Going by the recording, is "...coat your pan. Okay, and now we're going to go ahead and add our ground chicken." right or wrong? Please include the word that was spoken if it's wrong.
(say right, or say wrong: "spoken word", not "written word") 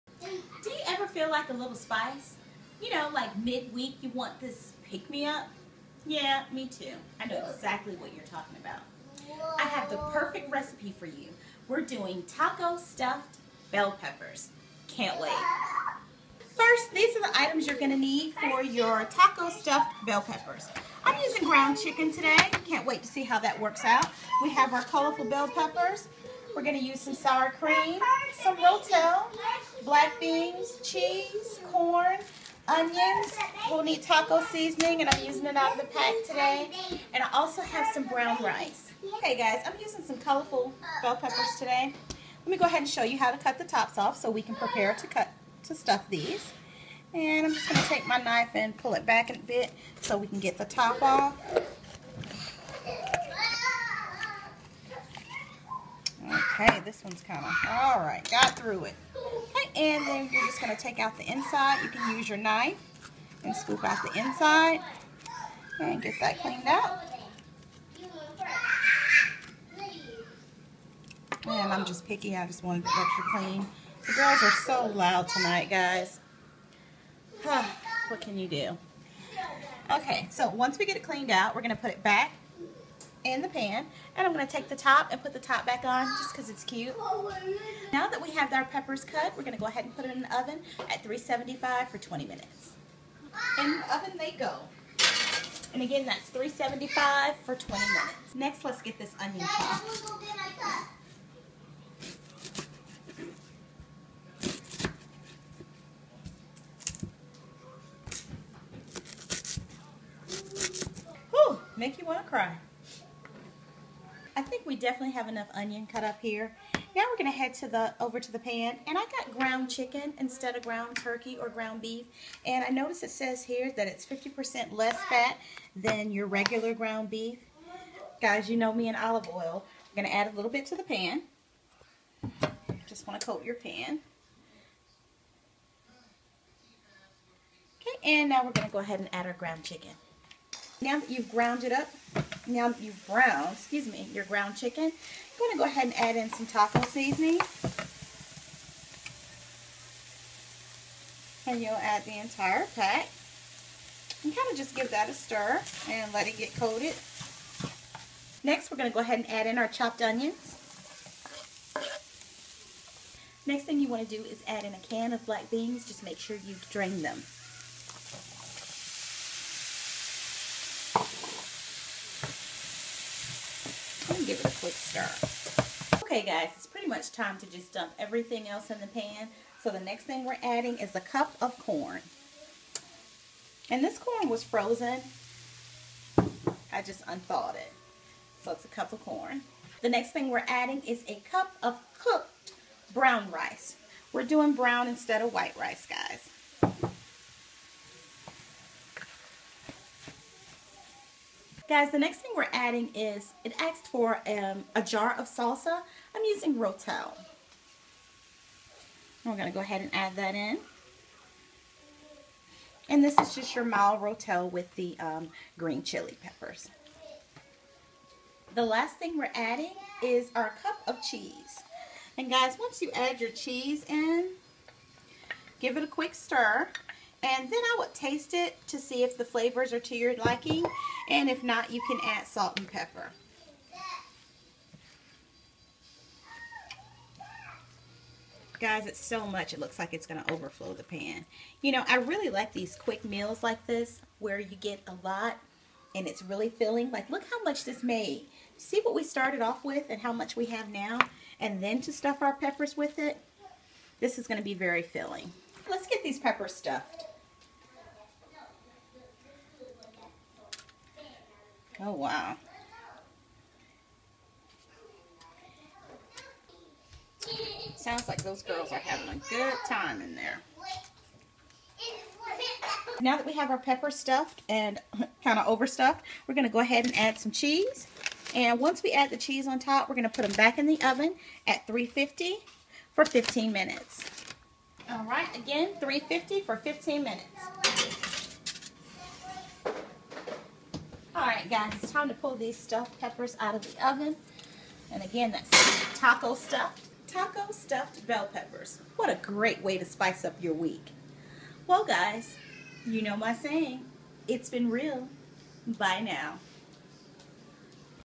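right.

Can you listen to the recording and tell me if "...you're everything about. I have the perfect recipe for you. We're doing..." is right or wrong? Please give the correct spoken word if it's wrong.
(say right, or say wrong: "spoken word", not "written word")
wrong: "talking", not "everything".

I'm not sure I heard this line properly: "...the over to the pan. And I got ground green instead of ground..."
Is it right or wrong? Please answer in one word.
wrong.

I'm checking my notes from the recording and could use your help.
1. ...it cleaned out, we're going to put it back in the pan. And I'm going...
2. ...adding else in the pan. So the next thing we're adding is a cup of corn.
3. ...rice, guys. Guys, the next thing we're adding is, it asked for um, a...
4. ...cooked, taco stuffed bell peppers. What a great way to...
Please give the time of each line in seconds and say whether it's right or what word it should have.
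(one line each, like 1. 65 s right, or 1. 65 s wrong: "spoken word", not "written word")
1. 80 s right
2. 177 s wrong: "everything", not "adding"
3. 195 s right
4. 296 s wrong: "stuffed", not "cooked".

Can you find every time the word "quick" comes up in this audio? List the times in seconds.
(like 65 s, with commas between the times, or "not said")
174 s, 225 s, 242 s.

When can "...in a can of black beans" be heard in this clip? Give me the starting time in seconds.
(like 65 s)
164 s.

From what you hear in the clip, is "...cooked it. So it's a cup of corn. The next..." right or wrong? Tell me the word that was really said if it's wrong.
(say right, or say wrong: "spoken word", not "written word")
wrong: "unthawed", not "cooked".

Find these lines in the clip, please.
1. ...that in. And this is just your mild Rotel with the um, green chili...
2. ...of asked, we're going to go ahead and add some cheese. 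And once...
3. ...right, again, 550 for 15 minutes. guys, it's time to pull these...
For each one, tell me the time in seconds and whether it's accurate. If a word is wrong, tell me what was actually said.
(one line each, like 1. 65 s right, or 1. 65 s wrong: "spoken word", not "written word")
1. 210 s right
2. 275 s wrong: "overstuffed", not "asked"
3. 285 s wrong: "350", not "550".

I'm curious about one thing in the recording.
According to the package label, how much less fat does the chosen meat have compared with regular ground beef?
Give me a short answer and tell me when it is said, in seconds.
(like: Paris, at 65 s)
50%, at 124 s.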